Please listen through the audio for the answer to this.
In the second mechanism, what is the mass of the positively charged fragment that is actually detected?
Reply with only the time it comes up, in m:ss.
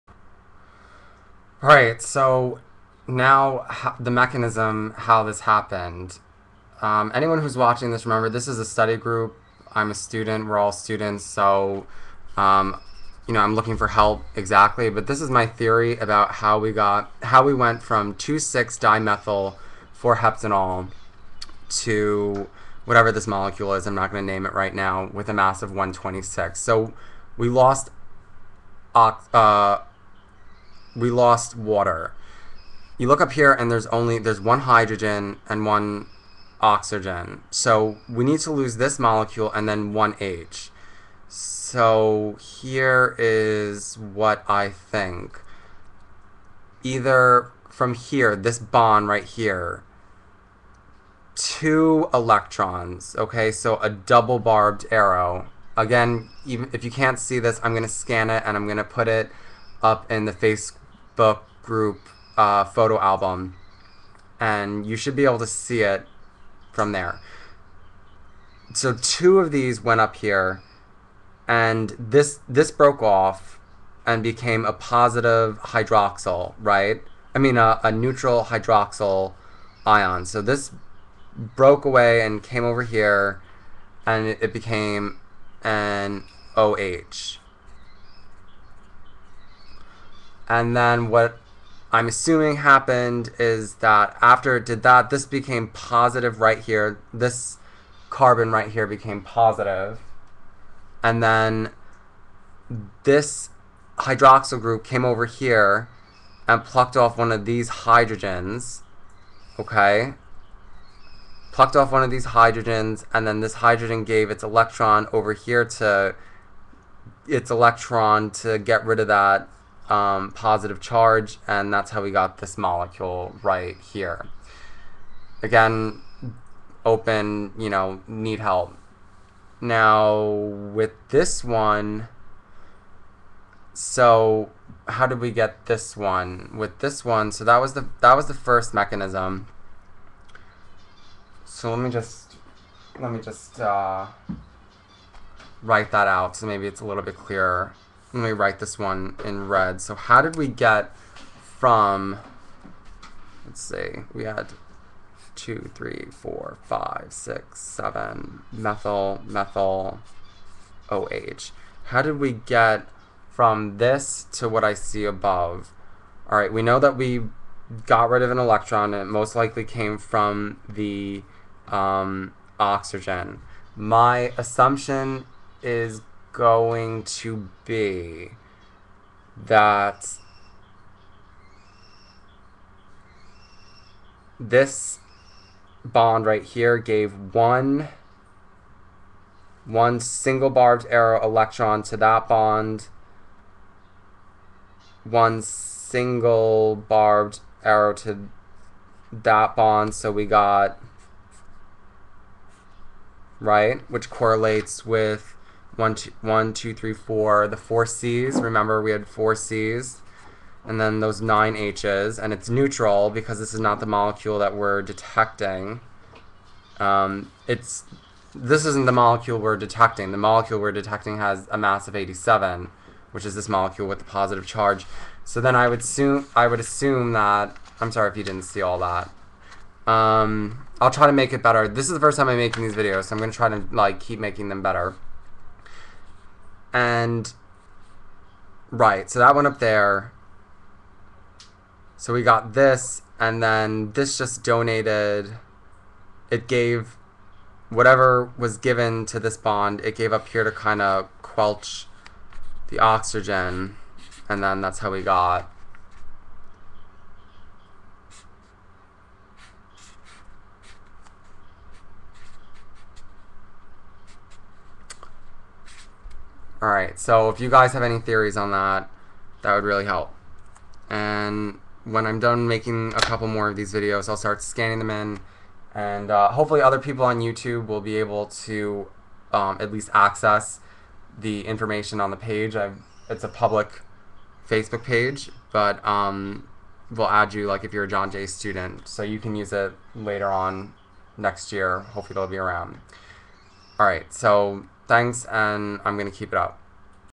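3:41.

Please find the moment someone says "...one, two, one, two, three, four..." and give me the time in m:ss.
3:25.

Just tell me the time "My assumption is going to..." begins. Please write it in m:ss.
2:53.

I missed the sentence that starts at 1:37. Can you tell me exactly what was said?
This carbon right here became positive.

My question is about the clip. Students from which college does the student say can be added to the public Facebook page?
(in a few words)
John Jay.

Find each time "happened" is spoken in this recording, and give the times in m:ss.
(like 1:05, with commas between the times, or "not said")
0:05, 1:32.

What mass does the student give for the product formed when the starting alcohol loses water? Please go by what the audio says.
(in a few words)
126.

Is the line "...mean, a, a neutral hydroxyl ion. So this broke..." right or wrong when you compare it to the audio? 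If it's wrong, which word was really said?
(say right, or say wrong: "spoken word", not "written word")
right.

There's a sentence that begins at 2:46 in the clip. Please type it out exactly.
All right, we know that we got rid of an electron.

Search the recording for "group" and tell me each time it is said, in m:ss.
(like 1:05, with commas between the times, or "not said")
0:08, 1:01, 1:44.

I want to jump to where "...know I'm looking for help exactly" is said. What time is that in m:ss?
0:13.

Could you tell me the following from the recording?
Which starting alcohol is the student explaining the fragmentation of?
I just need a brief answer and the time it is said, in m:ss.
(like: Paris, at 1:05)
2,6-dimethyl-4-heptanol, at 0:18.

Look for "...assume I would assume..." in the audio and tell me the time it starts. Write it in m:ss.
3:45.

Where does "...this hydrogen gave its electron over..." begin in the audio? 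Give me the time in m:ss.
1:53.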